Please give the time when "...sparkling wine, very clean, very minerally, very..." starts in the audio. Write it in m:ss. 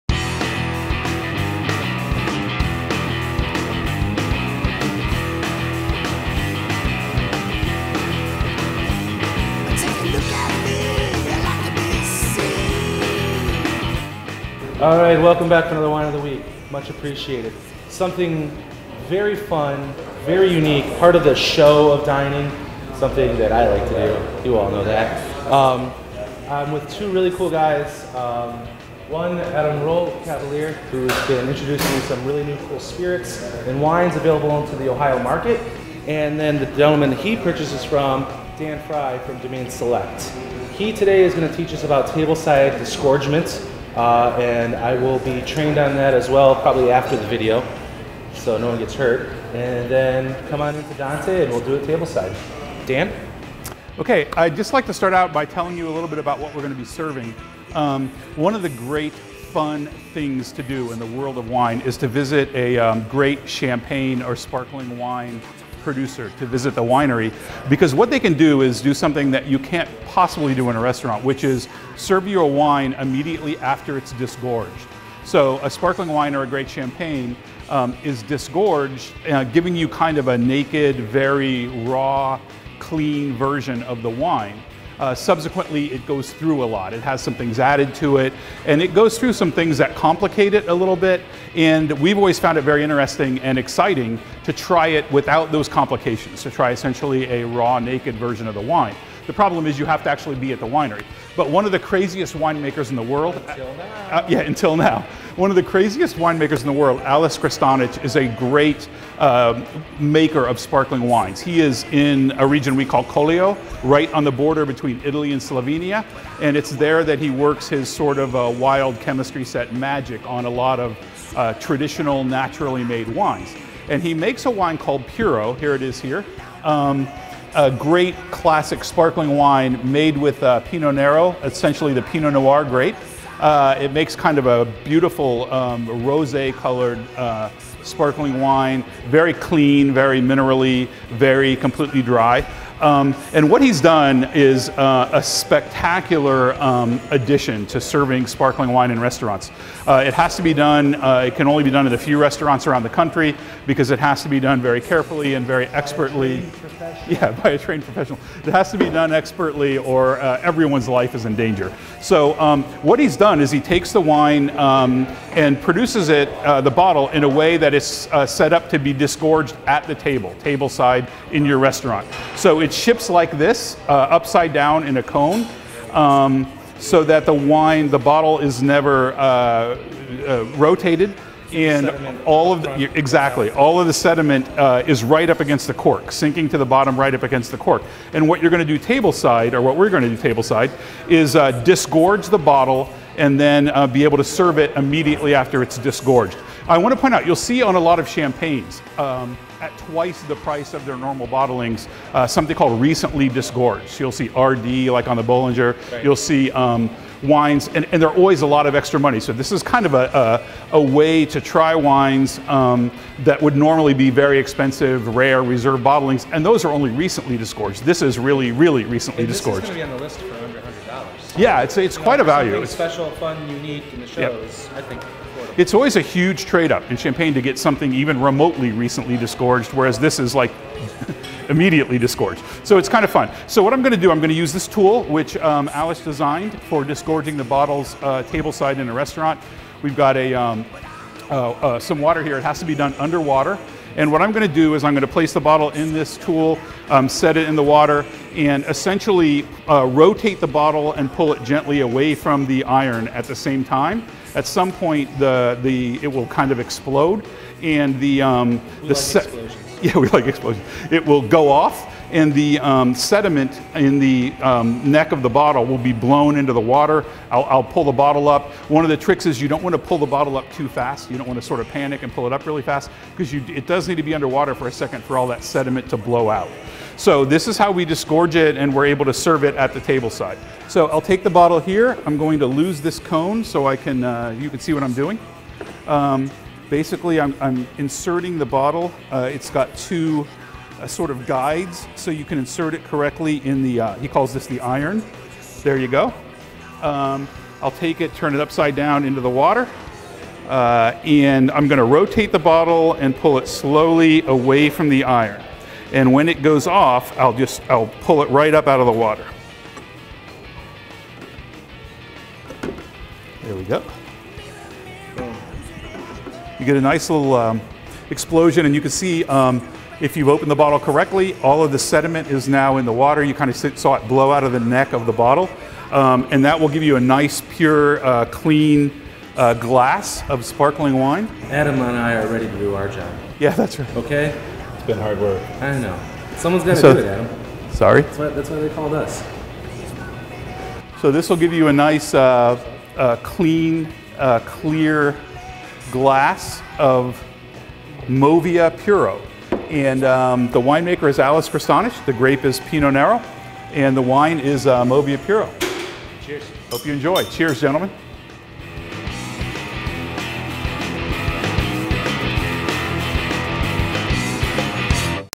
2:17.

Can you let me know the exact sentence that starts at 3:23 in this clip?
You'll see RD, like on the Bollinger.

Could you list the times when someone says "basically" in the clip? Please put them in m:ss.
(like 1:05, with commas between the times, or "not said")
4:46.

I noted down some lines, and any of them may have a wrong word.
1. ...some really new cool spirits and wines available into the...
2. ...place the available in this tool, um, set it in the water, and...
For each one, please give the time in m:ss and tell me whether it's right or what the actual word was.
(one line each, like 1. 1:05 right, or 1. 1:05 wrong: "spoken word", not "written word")
1. 0:32 right
2. 4:05 wrong: "bottle", not "available".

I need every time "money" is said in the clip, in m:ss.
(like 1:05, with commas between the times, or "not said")
3:28.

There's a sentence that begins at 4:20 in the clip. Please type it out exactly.
It will go off, and the um, sediment in the um, neck of the bottle will be blown into the water.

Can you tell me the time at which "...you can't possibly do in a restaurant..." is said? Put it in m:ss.
1:09.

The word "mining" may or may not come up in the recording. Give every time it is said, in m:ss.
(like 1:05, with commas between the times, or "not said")
not said.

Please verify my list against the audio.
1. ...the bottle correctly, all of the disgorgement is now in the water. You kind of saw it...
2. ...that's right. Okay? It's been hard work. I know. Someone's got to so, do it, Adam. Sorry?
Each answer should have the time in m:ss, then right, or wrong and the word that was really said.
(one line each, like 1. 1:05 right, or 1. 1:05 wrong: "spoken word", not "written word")
1. 5:20 wrong: "sediment", not "disgorgement"
2. 5:33 right.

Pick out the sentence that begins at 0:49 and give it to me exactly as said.
And then come on into Dante and we'll do it tableside.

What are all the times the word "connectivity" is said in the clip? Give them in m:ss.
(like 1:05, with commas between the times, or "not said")
not said.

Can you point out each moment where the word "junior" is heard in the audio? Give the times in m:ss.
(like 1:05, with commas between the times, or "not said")
not said.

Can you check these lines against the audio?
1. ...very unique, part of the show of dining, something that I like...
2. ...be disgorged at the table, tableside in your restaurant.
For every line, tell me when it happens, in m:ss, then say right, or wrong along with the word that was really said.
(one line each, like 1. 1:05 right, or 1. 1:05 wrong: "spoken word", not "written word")
1. 0:20 right
2. 2:48 right.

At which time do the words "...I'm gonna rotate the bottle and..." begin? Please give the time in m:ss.
5:01.